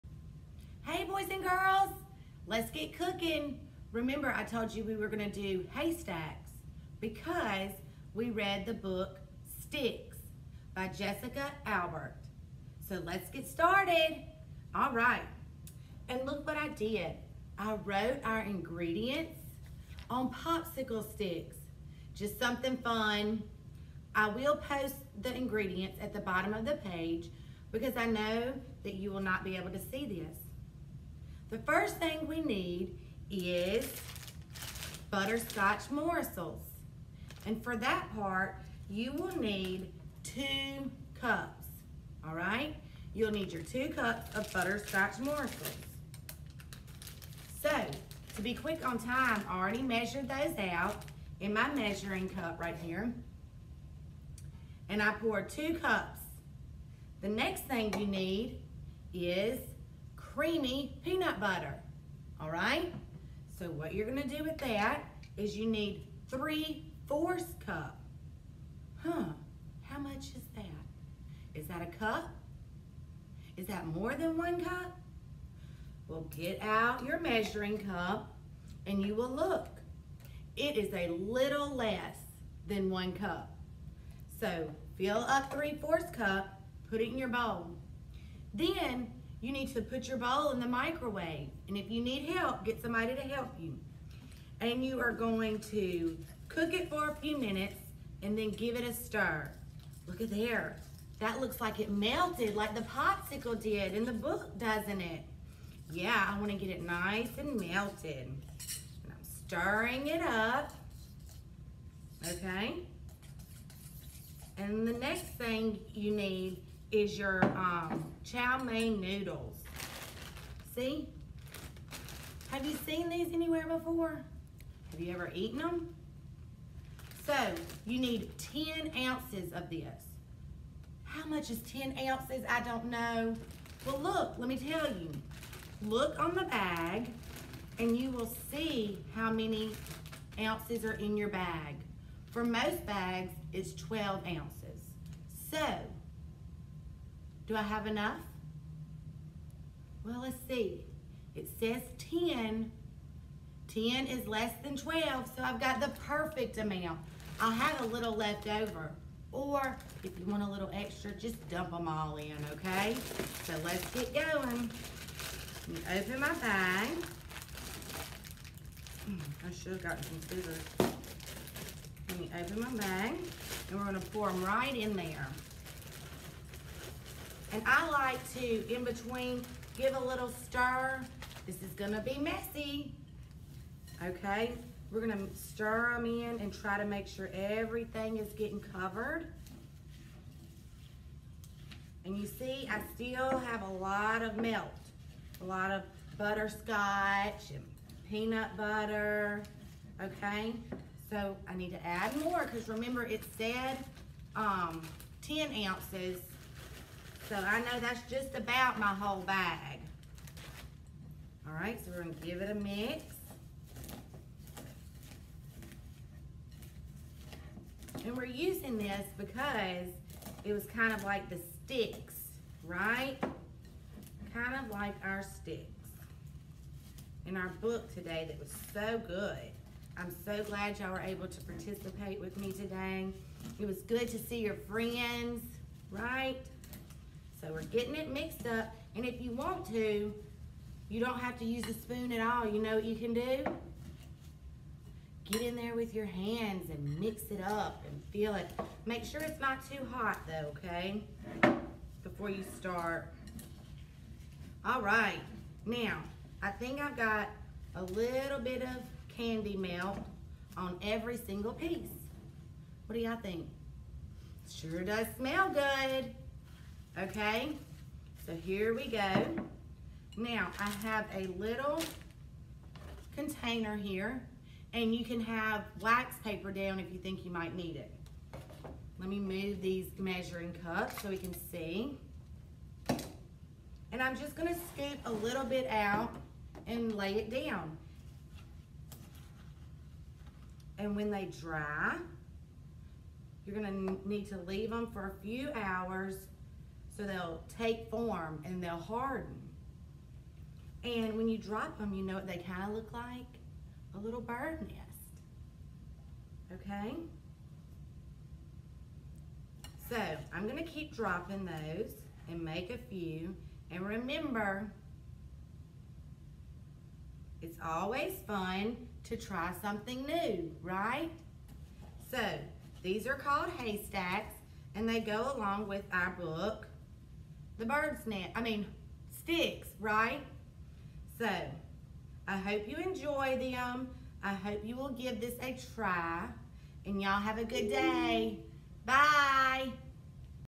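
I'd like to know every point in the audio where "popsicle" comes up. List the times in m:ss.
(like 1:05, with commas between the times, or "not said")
0:20, 1:42.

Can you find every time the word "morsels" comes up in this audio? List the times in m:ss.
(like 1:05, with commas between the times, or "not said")
0:35, 0:45.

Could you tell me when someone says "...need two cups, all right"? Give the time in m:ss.
0:39.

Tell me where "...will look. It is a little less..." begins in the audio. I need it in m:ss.
1:19.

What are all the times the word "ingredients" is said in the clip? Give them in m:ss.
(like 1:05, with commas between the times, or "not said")
0:18, 0:25.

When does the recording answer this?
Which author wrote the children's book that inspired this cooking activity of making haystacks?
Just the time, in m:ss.
0:10.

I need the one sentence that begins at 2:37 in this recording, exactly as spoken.
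I'll have a little left over.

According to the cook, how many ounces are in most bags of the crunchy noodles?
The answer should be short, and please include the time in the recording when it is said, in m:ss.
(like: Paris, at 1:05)
12 ounces, at 2:23.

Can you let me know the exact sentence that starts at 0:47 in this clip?
So, to be quick on time, I already measured those out in my measuring cup right here.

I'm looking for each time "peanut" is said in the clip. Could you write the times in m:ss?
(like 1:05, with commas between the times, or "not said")
1:01, 3:18.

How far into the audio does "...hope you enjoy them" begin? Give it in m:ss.
5:32.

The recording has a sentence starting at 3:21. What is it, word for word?
So I need to add more because remember it said um, 10 ounces so I know that's just about my whole bag.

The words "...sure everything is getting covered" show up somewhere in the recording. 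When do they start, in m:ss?
3:07.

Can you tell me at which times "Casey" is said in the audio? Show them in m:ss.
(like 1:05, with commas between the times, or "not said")
not said.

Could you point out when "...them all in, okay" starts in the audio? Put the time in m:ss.
2:41.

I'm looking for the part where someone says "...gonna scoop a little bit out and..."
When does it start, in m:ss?
4:44.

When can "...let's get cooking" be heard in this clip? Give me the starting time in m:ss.
0:02.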